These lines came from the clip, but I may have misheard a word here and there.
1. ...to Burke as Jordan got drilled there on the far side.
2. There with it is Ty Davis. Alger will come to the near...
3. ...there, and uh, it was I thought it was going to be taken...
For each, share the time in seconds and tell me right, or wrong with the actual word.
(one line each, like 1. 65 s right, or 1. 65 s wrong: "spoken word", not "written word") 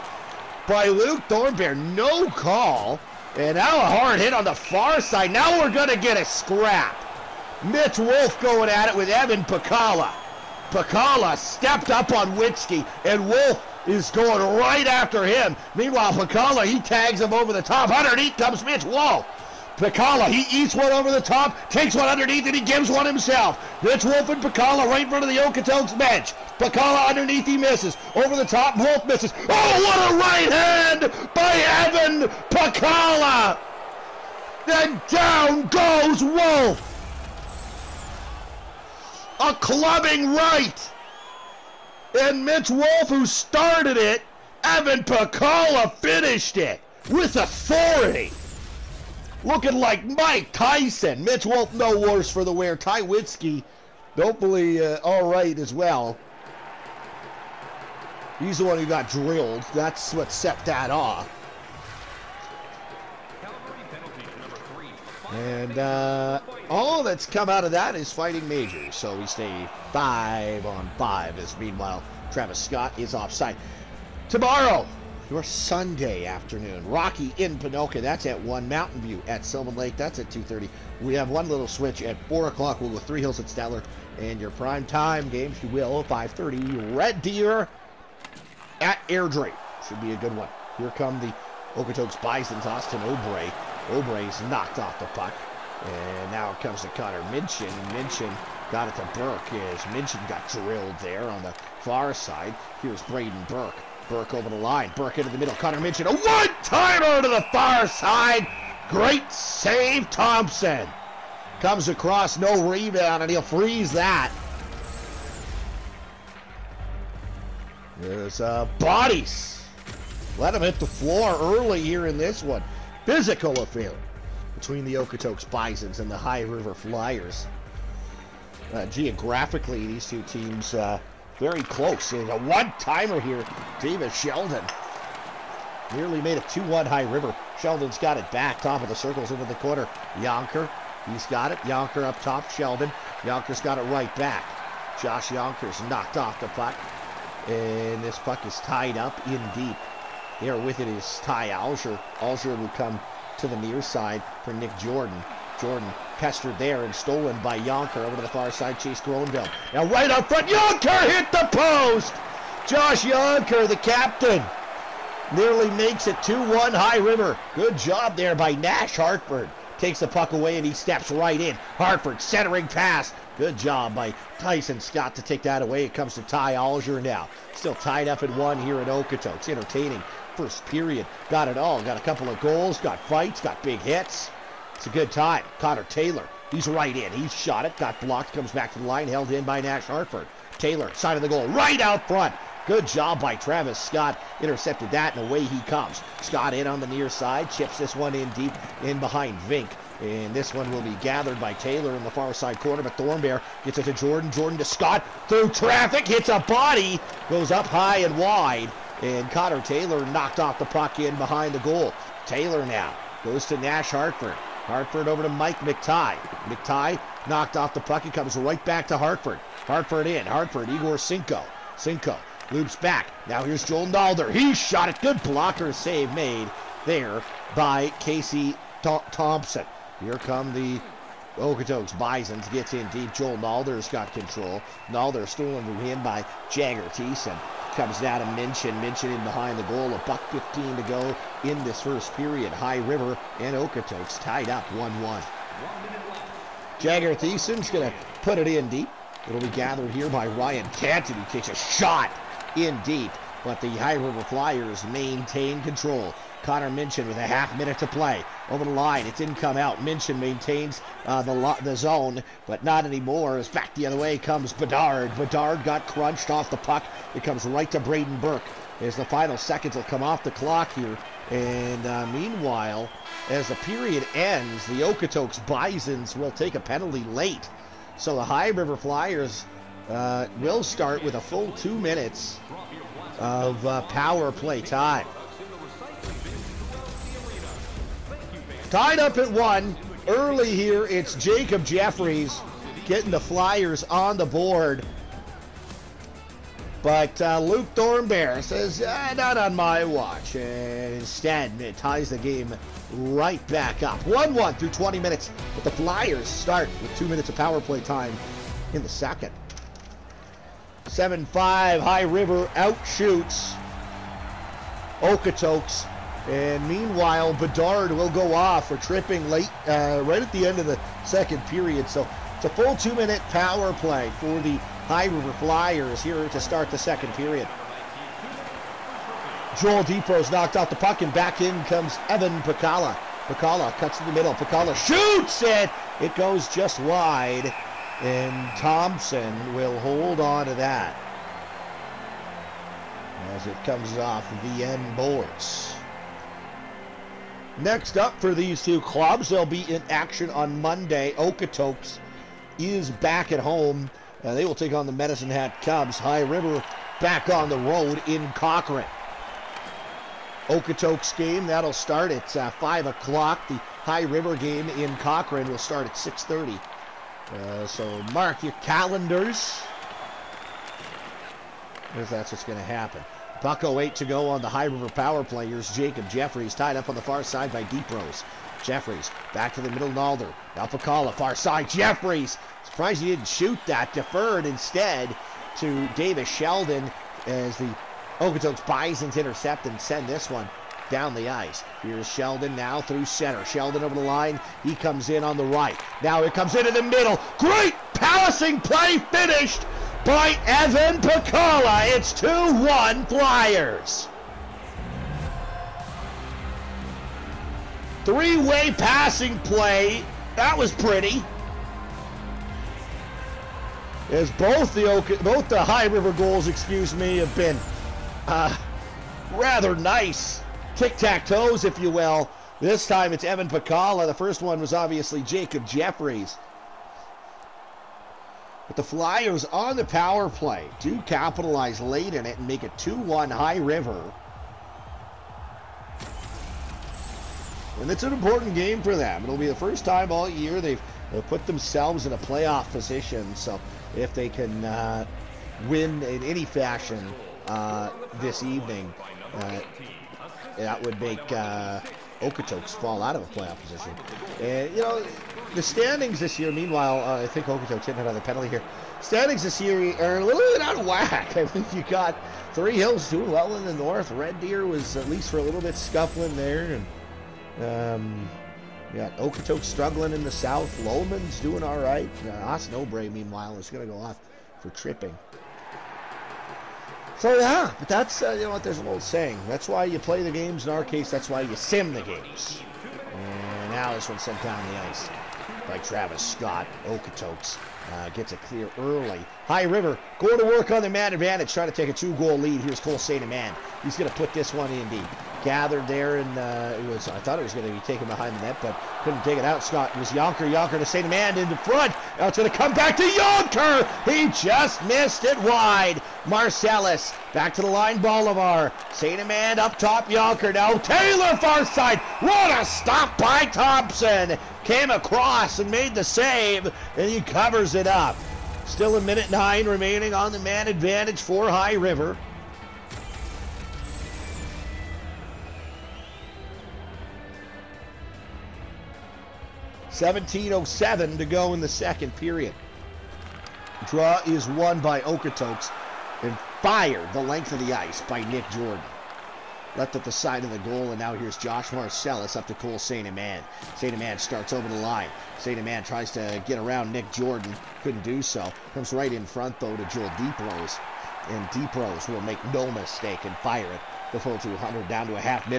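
1. 98 s wrong: "Minchin", not "Jordan"
2. 150 s wrong: "Alger", not "Davis"
3. 495 s right.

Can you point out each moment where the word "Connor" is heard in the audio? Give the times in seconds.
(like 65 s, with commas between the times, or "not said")
96 s, 105 s, 185 s, 209 s, 256 s.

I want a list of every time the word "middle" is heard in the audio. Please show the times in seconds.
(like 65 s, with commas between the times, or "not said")
105 s, 334 s, 379 s, 396 s.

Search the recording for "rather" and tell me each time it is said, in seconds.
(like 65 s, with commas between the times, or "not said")
419 s.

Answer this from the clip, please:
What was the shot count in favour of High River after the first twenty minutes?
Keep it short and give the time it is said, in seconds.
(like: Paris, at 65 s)
7-5, at 310 s.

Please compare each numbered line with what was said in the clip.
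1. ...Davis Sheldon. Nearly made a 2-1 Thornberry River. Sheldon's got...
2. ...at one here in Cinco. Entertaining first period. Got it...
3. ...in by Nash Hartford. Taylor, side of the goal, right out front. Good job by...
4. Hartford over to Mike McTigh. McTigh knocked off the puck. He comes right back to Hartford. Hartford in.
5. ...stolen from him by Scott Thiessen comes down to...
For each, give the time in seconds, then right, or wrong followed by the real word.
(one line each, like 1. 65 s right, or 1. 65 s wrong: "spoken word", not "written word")
1. 133 s wrong: "High", not "Thornberry"
2. 178 s wrong: "Okotoks", not "Cinco"
3. 189 s right
4. 214 s right
5. 235 s wrong: "Jagger", not "Scott".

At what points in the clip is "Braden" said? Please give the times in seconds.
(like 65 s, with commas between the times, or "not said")
103 s, 267 s.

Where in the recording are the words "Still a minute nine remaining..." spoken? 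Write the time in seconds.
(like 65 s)
518 s.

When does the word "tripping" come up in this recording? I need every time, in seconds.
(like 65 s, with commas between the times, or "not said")
318 s, 474 s.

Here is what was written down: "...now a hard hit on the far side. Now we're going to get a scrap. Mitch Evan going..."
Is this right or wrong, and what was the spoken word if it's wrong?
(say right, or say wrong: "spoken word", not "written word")
wrong: "Wolf", not "Evan".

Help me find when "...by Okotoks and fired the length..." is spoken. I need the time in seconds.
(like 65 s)
534 s.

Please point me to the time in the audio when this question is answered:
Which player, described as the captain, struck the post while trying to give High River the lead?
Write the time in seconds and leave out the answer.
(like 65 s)
162 s.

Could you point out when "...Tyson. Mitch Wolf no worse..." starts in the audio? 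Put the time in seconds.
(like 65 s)
50 s.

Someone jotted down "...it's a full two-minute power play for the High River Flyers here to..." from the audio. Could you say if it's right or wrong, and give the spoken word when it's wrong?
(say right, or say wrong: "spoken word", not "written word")
right.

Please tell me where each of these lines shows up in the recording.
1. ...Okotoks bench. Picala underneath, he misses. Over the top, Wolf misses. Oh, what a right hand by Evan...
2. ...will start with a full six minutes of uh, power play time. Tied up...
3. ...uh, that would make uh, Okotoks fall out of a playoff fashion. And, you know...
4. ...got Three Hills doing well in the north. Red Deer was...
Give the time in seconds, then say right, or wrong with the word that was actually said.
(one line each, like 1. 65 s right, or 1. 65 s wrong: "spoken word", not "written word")
1. 25 s right
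2. 280 s wrong: "two", not "six"
3. 449 s wrong: "position", not "fashion"
4. 461 s right.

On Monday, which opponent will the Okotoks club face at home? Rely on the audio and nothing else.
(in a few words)
Medicine Hat Cubs.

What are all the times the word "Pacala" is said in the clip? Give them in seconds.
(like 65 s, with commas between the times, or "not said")
380 s, 401 s, 423 s.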